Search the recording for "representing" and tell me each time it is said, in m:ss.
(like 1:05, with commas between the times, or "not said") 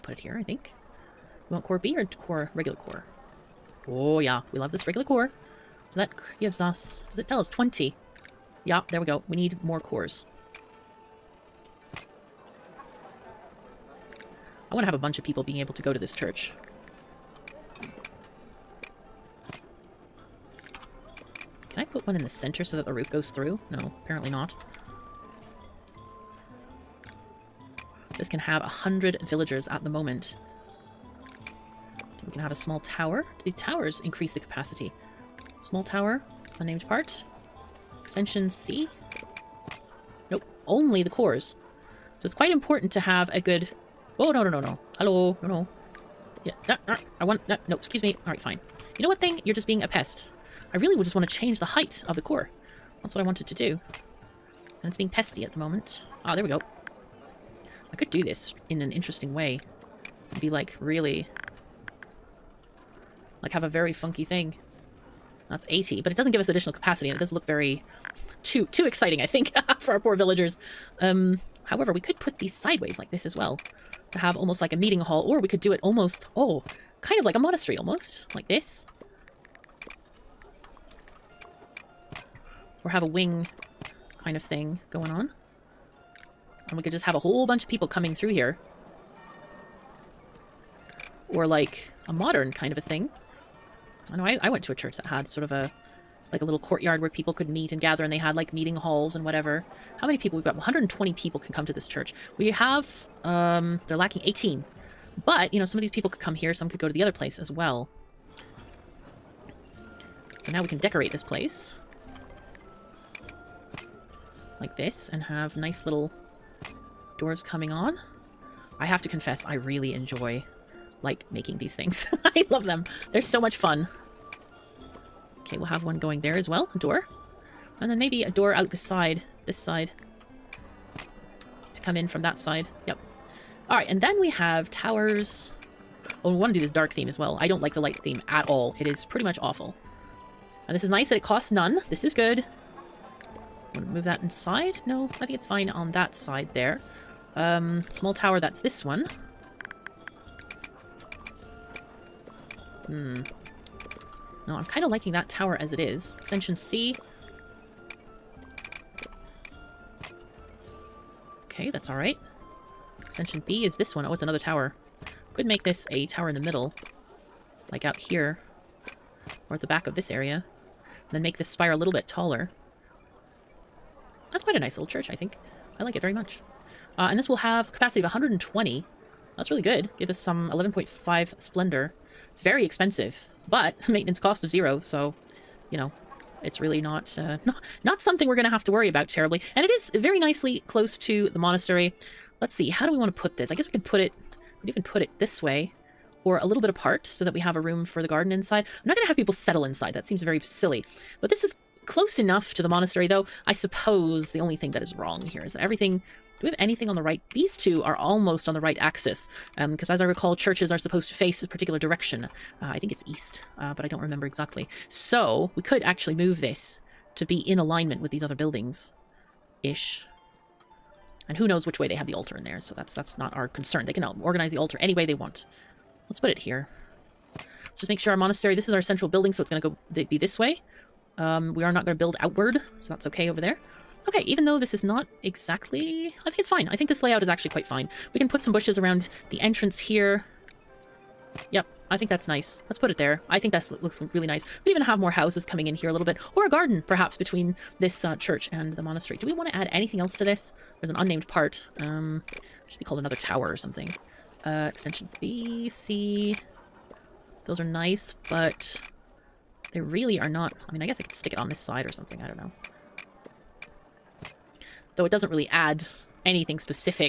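not said.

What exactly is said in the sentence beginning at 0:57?
I could do this in an interesting way.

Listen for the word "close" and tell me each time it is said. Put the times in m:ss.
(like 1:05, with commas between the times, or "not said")
3:10, 3:21.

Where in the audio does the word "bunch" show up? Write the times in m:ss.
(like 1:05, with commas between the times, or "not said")
0:14, 1:27.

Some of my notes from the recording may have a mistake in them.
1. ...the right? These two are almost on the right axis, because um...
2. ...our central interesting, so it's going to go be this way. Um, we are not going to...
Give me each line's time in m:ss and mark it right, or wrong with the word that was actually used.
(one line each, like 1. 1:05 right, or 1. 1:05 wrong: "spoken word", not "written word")
1. 3:26 right
2. 3:48 wrong: "building", not "interesting".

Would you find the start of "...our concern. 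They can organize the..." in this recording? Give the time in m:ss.
3:43.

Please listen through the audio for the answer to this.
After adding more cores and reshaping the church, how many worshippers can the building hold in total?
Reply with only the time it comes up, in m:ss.
1:40.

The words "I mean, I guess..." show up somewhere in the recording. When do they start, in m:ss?
4:20.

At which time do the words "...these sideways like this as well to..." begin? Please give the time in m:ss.
1:12.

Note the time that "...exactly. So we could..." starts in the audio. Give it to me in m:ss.
3:34.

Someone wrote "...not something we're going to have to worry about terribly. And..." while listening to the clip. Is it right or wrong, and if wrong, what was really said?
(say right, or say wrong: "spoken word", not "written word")
right.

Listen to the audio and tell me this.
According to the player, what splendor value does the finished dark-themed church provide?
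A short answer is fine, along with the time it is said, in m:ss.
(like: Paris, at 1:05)
11.5, at 3:00.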